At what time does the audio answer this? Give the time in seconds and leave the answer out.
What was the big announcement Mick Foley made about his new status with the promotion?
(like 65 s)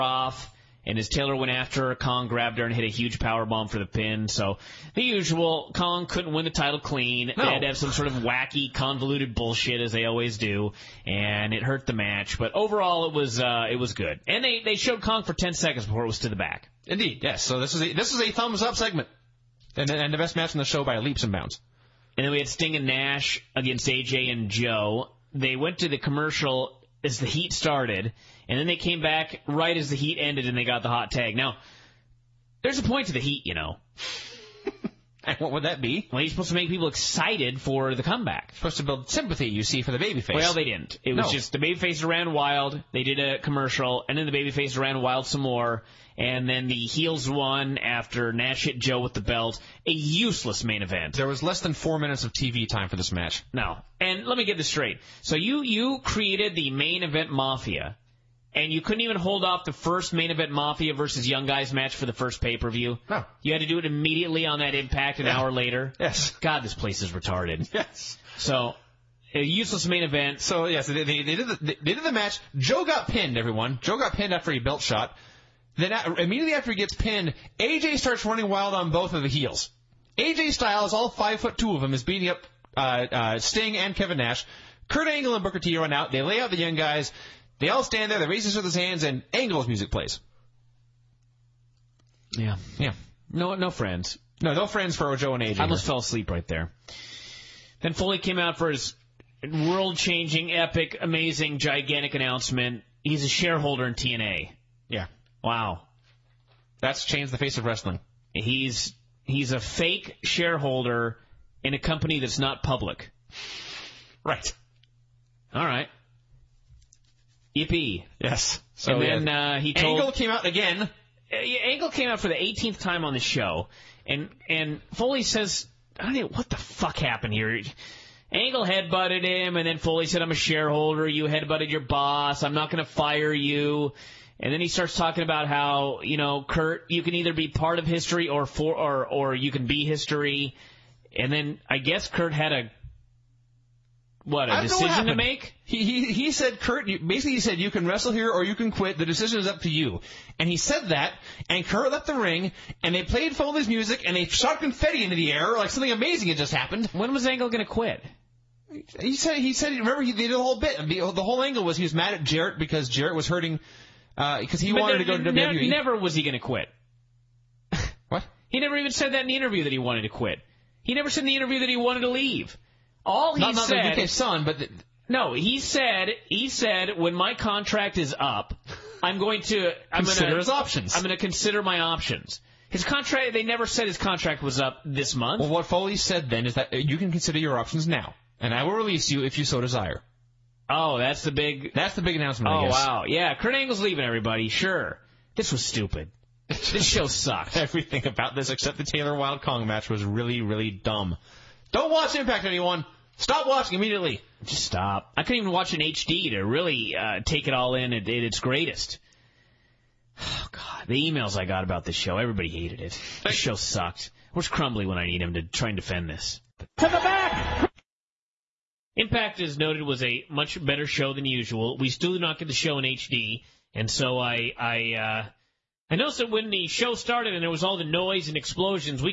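103 s.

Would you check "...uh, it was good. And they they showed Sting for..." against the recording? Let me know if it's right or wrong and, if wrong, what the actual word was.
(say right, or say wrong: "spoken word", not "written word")
wrong: "Kong", not "Sting".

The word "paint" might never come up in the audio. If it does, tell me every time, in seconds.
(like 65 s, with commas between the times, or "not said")
not said.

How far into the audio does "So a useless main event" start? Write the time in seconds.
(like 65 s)
68 s.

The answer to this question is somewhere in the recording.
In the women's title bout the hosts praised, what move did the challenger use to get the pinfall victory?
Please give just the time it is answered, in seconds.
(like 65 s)
3 s.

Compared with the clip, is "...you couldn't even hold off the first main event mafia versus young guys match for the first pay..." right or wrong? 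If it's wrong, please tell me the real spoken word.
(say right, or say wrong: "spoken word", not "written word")
right.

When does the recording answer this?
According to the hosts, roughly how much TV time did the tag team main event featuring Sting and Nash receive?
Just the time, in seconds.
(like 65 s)
51 s.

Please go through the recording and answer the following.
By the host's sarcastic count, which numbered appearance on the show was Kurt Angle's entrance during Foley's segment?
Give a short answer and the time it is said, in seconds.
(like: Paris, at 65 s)
18th, at 122 s.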